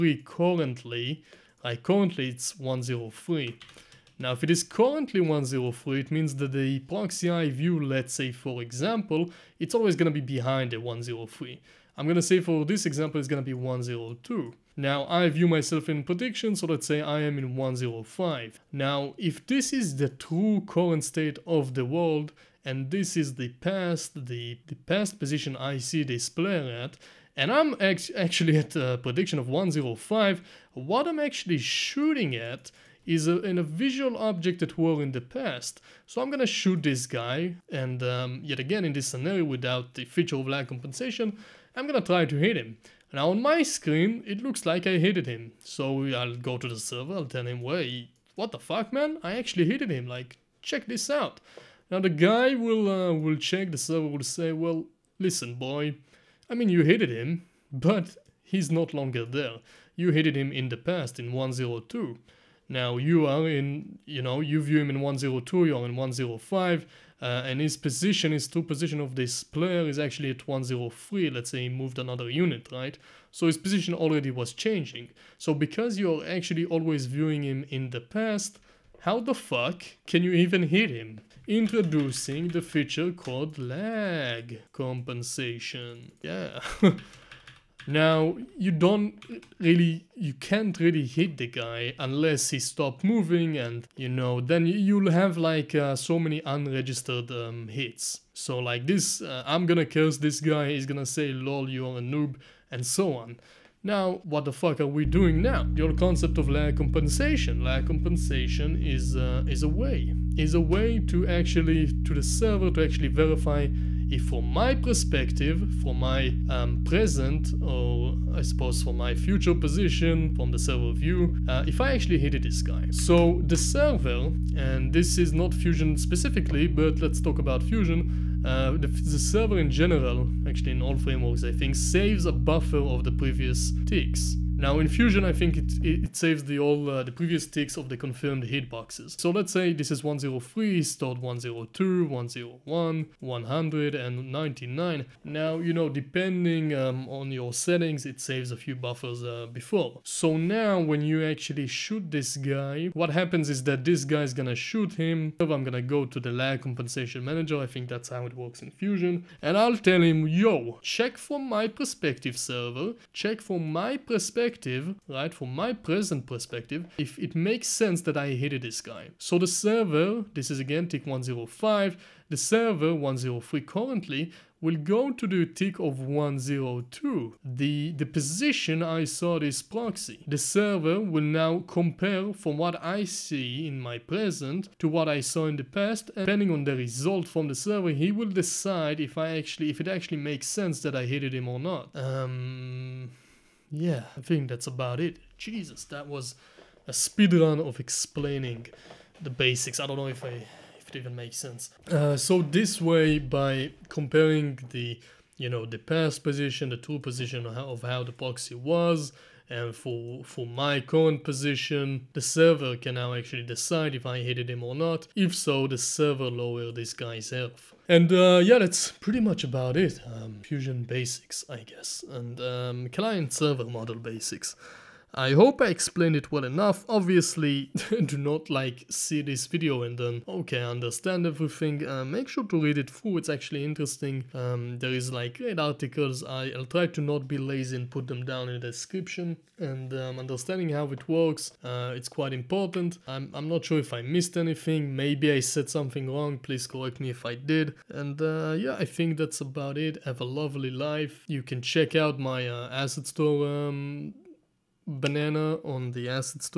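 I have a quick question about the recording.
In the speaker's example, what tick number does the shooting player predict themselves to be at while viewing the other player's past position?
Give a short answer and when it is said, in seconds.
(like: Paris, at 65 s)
105, at 16 s.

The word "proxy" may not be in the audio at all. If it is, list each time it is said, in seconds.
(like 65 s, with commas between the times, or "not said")
6 s, 179 s, 208 s.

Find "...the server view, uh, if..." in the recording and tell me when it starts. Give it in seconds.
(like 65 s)
120 s.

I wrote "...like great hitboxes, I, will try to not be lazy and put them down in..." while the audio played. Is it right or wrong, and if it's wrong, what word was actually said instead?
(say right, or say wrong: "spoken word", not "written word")
wrong: "articles", not "hitboxes".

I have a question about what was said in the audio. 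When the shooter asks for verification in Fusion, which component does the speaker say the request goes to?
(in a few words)
Lag compensation manager.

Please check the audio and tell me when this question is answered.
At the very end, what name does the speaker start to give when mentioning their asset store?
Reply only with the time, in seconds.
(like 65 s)
254 s.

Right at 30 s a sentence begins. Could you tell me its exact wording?
What I'm actually shooting at is a, in a visual object at war in the past.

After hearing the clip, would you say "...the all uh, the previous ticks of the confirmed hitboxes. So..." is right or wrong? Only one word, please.
right.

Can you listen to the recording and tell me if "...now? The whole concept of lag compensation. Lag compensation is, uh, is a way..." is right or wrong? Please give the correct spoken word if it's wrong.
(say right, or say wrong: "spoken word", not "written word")
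right.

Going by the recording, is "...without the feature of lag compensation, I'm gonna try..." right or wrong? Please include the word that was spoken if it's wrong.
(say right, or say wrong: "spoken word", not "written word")
right.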